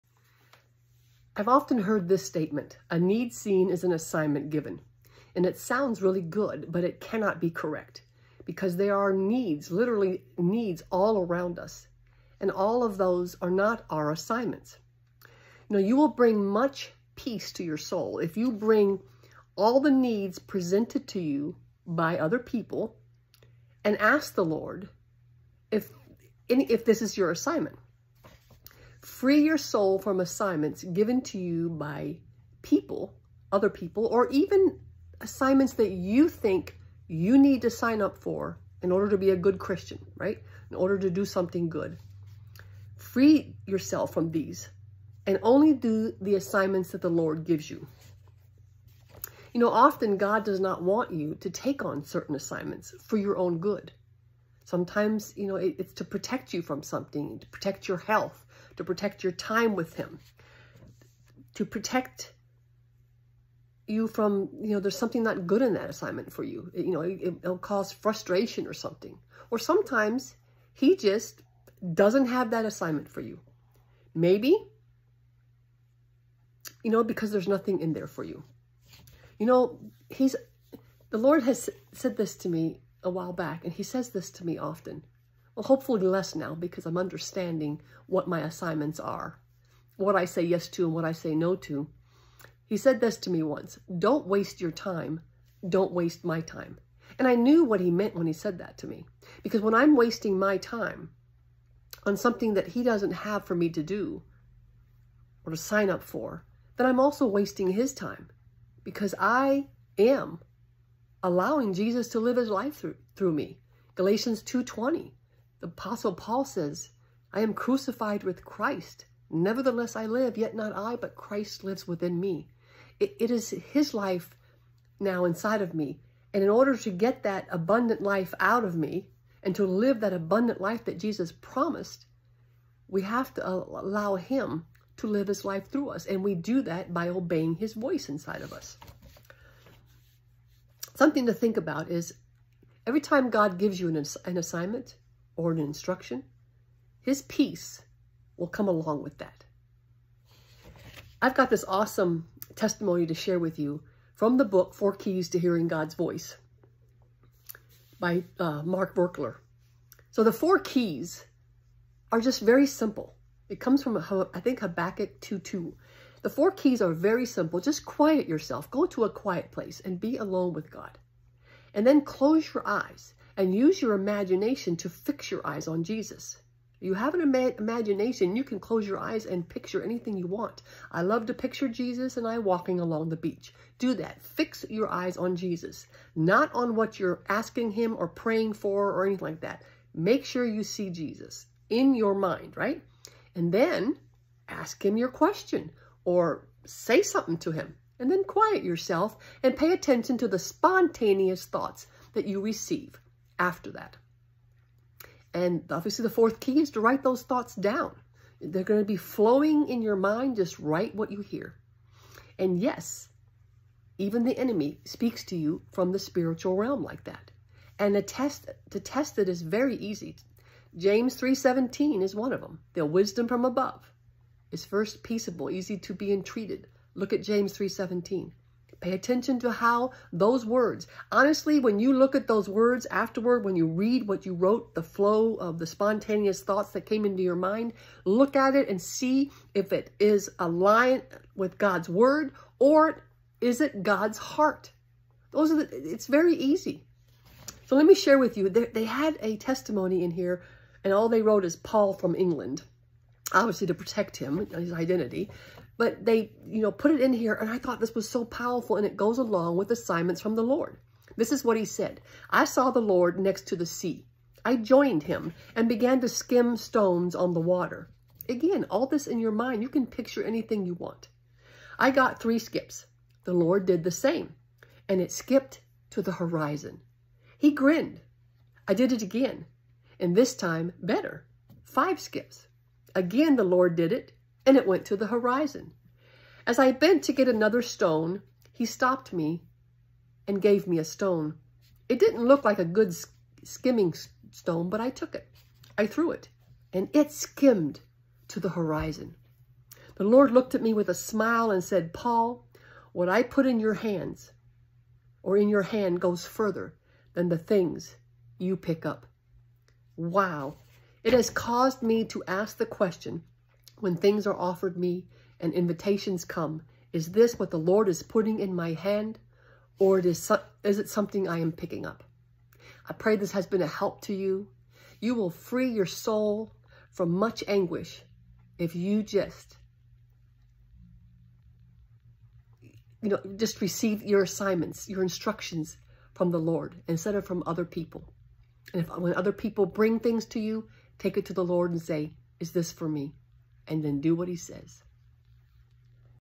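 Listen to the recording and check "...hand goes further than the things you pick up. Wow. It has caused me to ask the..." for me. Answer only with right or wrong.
right.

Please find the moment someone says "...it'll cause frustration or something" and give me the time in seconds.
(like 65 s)
67 s.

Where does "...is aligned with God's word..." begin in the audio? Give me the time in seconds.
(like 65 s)
239 s.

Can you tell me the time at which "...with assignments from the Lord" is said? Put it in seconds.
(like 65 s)
259 s.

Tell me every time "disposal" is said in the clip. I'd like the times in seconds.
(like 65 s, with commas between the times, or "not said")
not said.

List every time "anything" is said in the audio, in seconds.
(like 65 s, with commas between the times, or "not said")
179 s, 189 s, 270 s.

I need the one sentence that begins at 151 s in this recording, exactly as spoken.
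I've got this awesome testimony to share with you from the book, Four Keys to Hearing God's Voice by uh, Mark Virkler.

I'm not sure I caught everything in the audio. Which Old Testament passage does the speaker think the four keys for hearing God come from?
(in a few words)
Habakkuk 2:2.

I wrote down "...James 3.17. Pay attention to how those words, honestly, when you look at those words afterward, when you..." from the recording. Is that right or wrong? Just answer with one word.
right.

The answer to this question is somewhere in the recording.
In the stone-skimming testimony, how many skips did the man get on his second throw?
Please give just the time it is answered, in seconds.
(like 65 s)
281 s.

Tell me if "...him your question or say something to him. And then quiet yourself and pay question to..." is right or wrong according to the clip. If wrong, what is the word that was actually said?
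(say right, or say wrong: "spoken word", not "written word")
wrong: "attention", not "question".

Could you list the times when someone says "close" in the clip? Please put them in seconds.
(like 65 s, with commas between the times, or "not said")
172 s, 178 s.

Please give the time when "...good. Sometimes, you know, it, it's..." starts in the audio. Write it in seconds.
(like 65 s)
53 s.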